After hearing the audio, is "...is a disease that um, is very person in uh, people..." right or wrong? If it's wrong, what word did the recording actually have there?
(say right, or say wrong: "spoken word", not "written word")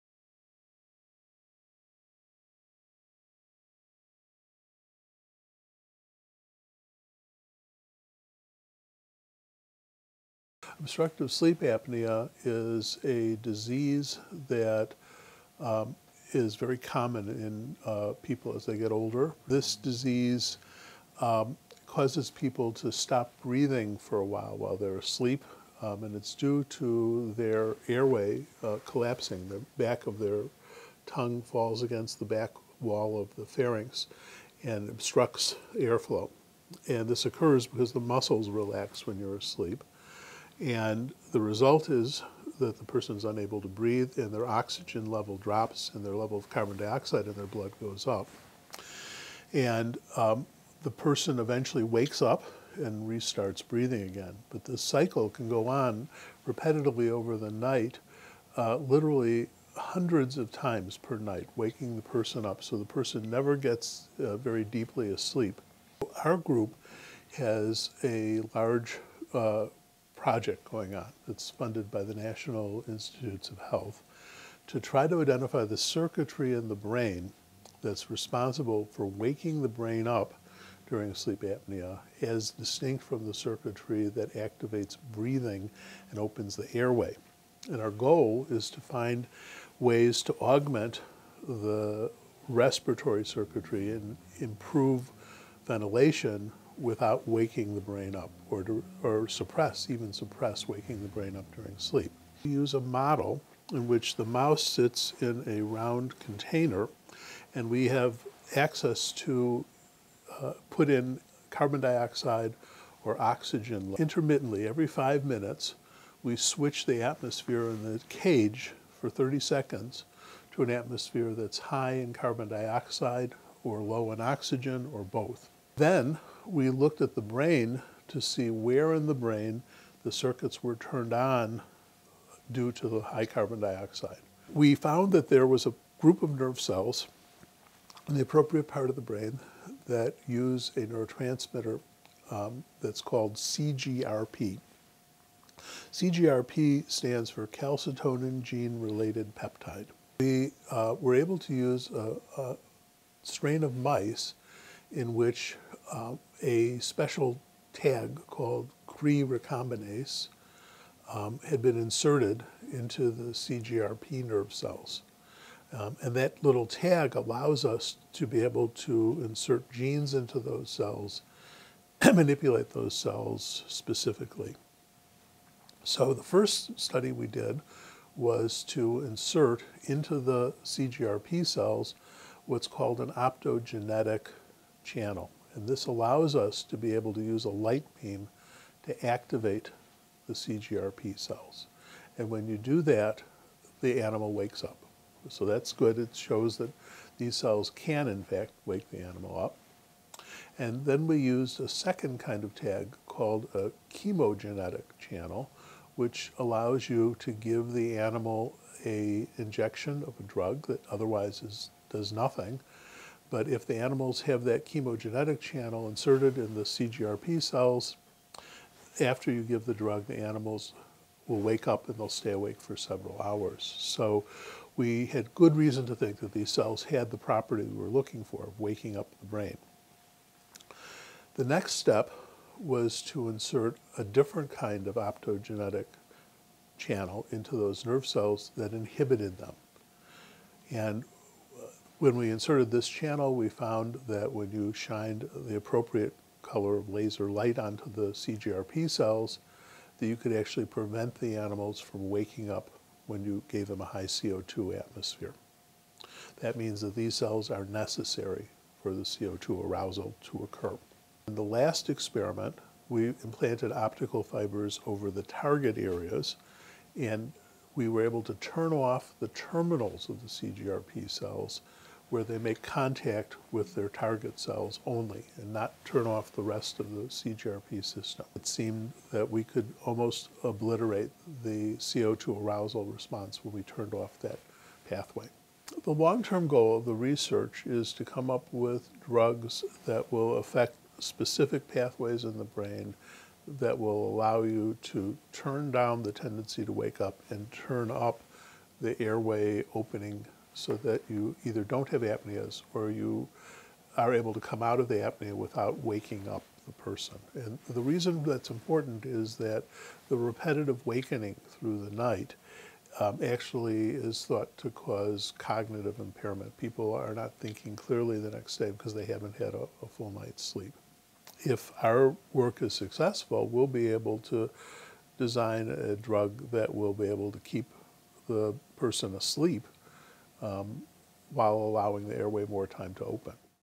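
wrong: "common", not "person".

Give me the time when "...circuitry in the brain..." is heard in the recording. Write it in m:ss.
1:15.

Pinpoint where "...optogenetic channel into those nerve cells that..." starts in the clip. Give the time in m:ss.
3:54.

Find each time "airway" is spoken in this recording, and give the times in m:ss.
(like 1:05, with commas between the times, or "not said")
0:27, 1:26, 4:59, 5:32.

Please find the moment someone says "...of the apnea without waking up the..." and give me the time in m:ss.
5:04.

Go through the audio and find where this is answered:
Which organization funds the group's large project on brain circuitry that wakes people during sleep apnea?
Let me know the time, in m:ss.
1:12.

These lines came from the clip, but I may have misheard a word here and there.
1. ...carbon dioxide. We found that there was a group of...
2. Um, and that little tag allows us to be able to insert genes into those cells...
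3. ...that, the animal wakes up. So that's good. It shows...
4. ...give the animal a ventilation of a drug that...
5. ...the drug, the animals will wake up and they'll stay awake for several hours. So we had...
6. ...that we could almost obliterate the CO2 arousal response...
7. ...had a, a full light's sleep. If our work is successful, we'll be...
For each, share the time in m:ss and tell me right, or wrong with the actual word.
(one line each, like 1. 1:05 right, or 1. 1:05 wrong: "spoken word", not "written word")
1. 2:13 right
2. 2:45 right
3. 3:12 right
4. 3:27 wrong: "injection", not "ventilation"
5. 3:39 right
6. 4:39 right
7. 5:19 wrong: "night", not "light".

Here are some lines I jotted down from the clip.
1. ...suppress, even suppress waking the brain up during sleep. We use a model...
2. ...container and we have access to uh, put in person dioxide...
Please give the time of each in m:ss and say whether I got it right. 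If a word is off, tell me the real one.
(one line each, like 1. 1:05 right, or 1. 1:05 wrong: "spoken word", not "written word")
1. 1:39 right
2. 1:46 wrong: "carbon", not "person".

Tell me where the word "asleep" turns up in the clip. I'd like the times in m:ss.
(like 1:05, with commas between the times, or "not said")
0:24, 0:39, 1:05, 5:29.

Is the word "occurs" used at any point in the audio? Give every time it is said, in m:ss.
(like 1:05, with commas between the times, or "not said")
0:37, 4:20.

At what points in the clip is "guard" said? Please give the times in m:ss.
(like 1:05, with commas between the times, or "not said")
not said.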